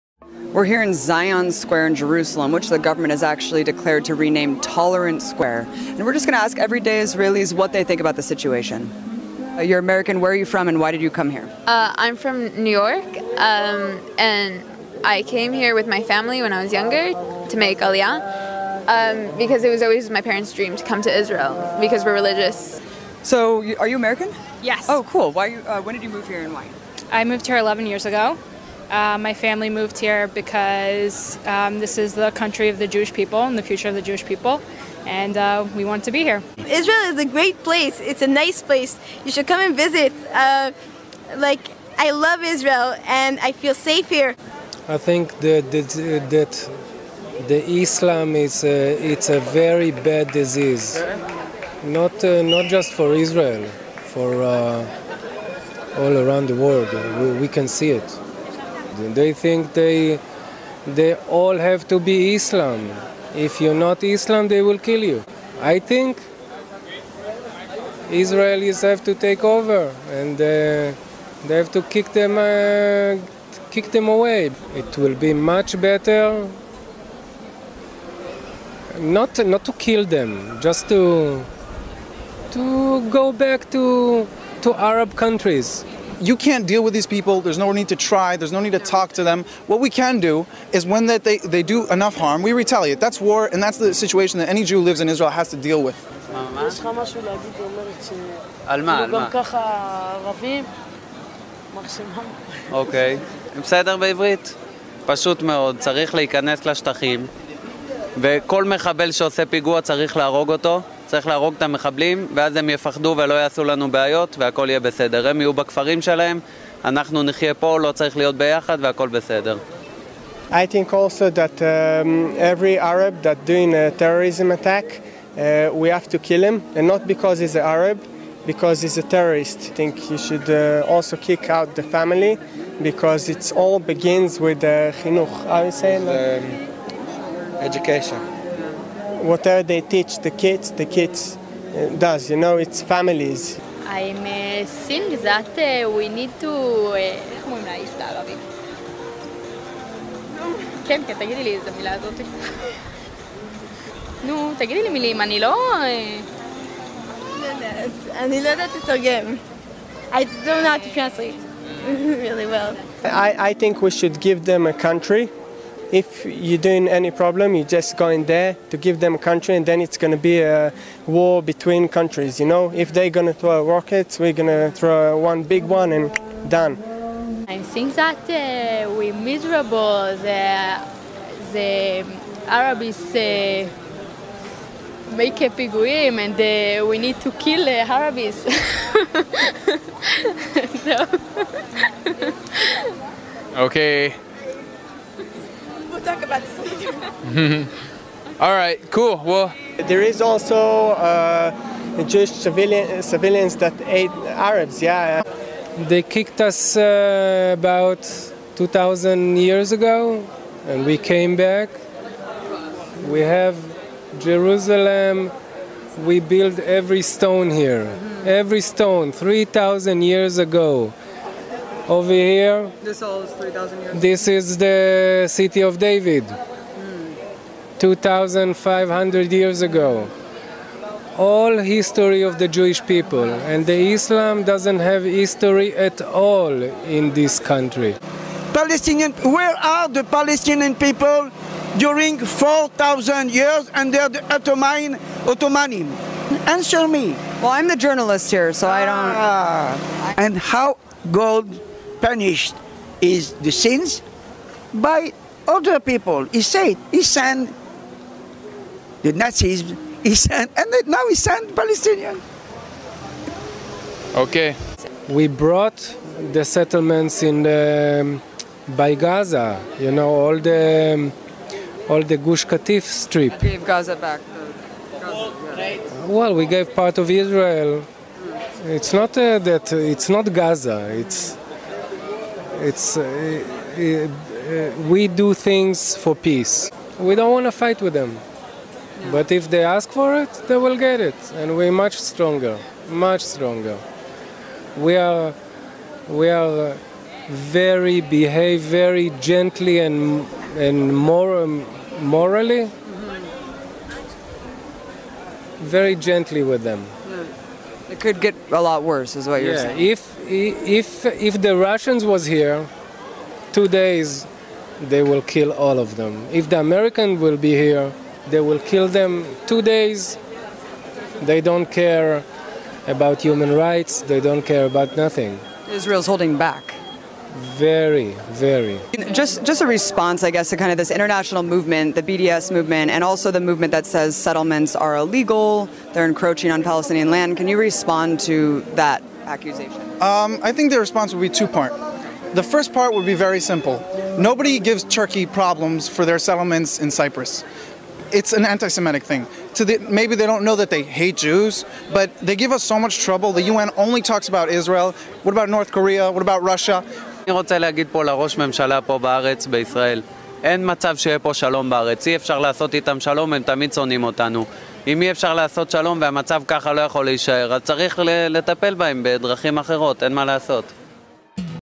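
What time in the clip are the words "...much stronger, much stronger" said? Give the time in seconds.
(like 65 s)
291 s.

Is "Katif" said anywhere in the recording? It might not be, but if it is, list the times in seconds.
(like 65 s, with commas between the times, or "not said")
272 s.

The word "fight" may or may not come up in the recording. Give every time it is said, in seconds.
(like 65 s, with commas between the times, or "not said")
287 s.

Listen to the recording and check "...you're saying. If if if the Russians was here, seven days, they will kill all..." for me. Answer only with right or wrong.
wrong.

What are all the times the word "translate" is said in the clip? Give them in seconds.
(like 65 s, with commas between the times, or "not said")
160 s.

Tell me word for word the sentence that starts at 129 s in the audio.
I think you should uh, also kick out the family, because it all begins with uh, chinuch.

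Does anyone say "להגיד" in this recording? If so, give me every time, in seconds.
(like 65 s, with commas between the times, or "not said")
97 s, 357 s.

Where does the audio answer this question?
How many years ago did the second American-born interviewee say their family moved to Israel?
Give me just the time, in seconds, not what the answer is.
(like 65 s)
27 s.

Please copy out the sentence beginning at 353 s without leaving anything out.
The UN only talks about Israel.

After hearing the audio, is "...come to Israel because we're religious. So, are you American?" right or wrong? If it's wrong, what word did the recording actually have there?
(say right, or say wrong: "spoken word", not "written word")
right.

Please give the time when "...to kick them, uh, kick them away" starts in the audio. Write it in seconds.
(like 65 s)
71 s.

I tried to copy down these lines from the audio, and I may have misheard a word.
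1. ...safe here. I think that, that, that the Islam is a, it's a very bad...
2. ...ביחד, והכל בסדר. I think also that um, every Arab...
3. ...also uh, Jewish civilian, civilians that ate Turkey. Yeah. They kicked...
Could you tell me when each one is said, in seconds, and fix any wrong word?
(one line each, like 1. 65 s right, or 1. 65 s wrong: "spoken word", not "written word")
1. 43 s right
2. 118 s right
3. 200 s wrong: "Arabs", not "Turkey".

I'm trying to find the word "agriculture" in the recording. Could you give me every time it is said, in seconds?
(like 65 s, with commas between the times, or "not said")
not said.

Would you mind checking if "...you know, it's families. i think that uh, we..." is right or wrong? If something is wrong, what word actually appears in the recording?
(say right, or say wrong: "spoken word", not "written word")
right.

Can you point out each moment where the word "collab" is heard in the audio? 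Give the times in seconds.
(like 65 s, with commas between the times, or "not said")
not said.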